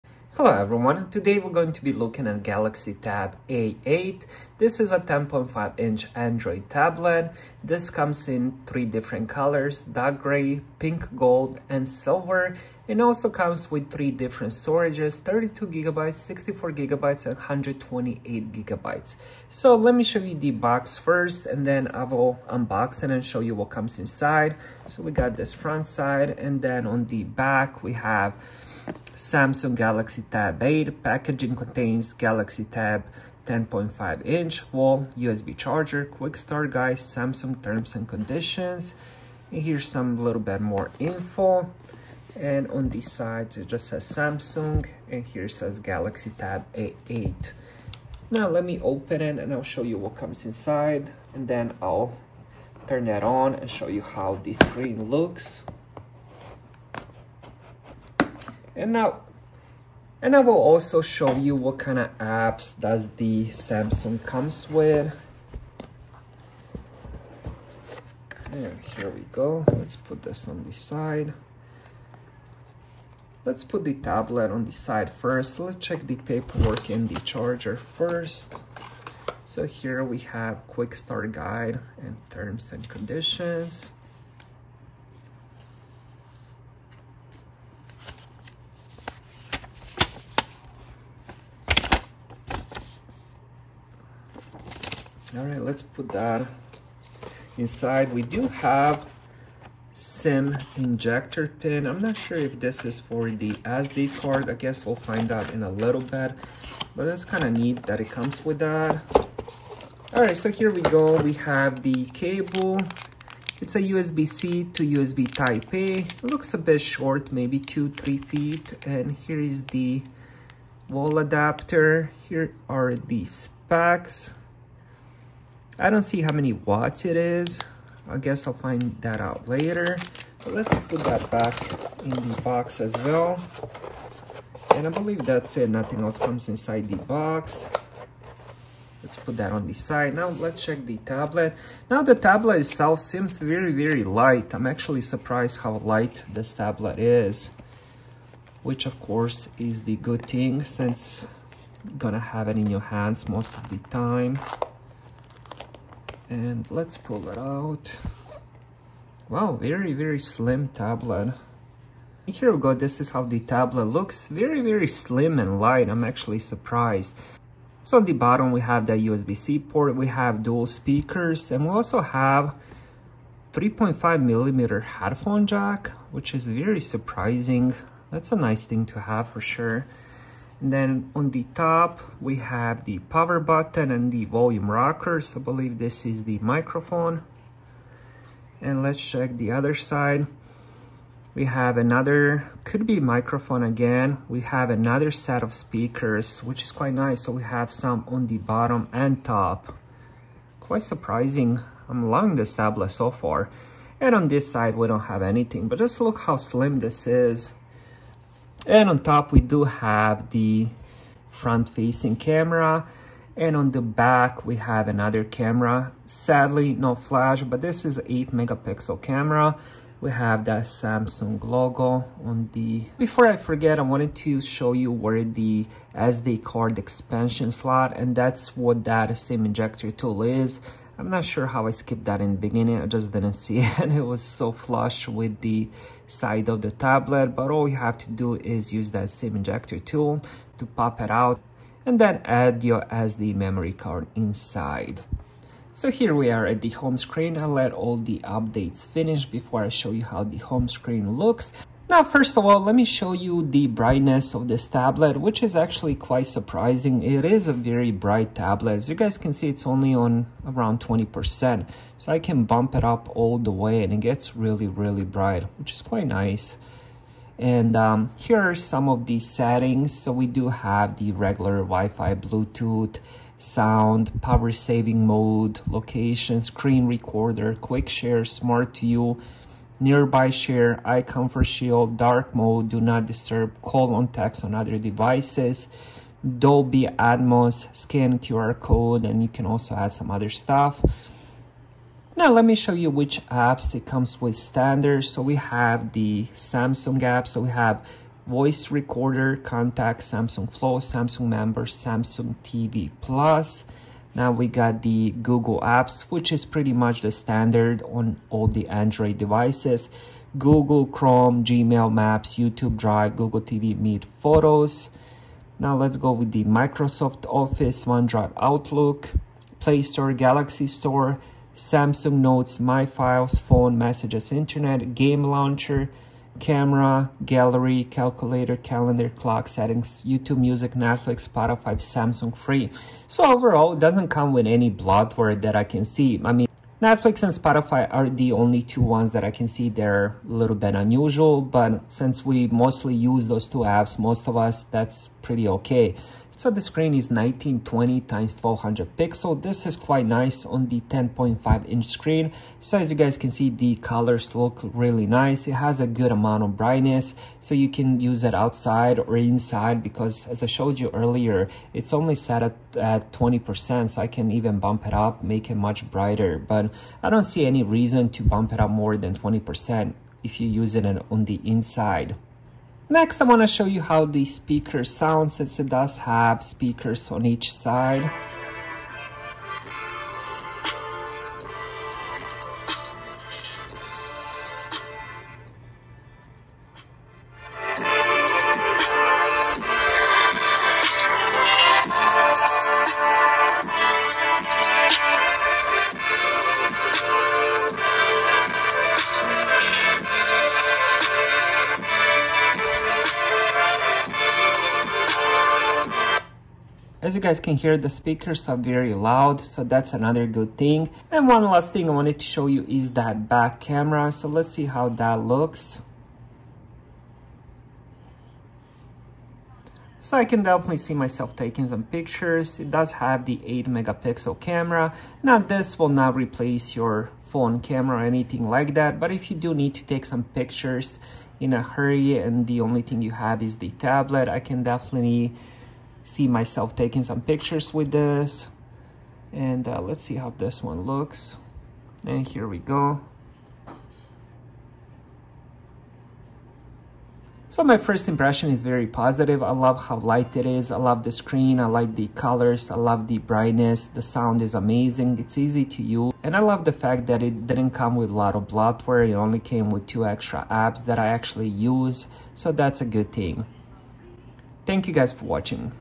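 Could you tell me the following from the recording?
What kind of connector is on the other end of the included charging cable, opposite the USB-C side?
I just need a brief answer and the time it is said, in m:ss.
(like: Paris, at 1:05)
USB type A, at 1:54.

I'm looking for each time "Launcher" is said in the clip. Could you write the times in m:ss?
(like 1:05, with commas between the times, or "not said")
5:25.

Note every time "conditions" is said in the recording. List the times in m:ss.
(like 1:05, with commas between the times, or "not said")
0:38, 1:22.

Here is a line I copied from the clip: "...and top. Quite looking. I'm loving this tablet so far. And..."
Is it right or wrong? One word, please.
wrong.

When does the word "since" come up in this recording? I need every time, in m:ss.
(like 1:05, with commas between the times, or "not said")
2:30, 5:41, 6:15.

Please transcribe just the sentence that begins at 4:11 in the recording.
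Now, first of all, let me show you the brightness of this tablet, which is actually quite surprising.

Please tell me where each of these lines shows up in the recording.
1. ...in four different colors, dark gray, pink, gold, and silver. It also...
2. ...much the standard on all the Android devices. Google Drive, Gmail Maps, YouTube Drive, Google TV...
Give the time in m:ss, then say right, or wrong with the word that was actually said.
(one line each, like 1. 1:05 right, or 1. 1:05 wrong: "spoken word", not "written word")
1. 0:08 wrong: "three", not "four"
2. 5:06 wrong: "Chrome", not "Drive".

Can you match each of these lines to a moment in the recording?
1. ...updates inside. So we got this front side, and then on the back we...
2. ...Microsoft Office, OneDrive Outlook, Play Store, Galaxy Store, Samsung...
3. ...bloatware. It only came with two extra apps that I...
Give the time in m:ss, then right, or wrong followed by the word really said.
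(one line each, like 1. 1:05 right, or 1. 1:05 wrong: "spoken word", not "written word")
1. 0:23 wrong: "comes", not "updates"
2. 5:16 right
3. 7:38 right.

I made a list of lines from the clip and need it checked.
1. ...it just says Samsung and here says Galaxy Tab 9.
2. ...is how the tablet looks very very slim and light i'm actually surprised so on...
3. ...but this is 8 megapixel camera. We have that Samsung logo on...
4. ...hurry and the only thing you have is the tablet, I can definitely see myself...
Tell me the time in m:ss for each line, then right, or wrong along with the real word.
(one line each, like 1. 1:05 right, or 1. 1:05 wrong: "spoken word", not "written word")
1. 0:43 wrong: "8", not "9"
2. 2:43 right
3. 3:37 right
4. 7:11 right.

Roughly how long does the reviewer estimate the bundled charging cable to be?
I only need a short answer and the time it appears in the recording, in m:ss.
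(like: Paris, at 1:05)
2-3 feet, at 1:57.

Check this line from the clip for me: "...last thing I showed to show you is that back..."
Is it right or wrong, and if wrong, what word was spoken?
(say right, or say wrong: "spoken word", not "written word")
wrong: "wanted", not "showed".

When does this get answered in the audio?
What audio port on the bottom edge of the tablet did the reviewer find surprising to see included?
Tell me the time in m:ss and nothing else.
2:53.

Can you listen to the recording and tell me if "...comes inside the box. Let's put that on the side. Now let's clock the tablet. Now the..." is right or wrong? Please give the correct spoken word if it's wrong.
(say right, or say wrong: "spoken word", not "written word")
wrong: "check", not "clock".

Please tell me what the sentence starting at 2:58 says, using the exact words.
That's a nice thing to have for sure then on the top, we have the power button and the volume rockers.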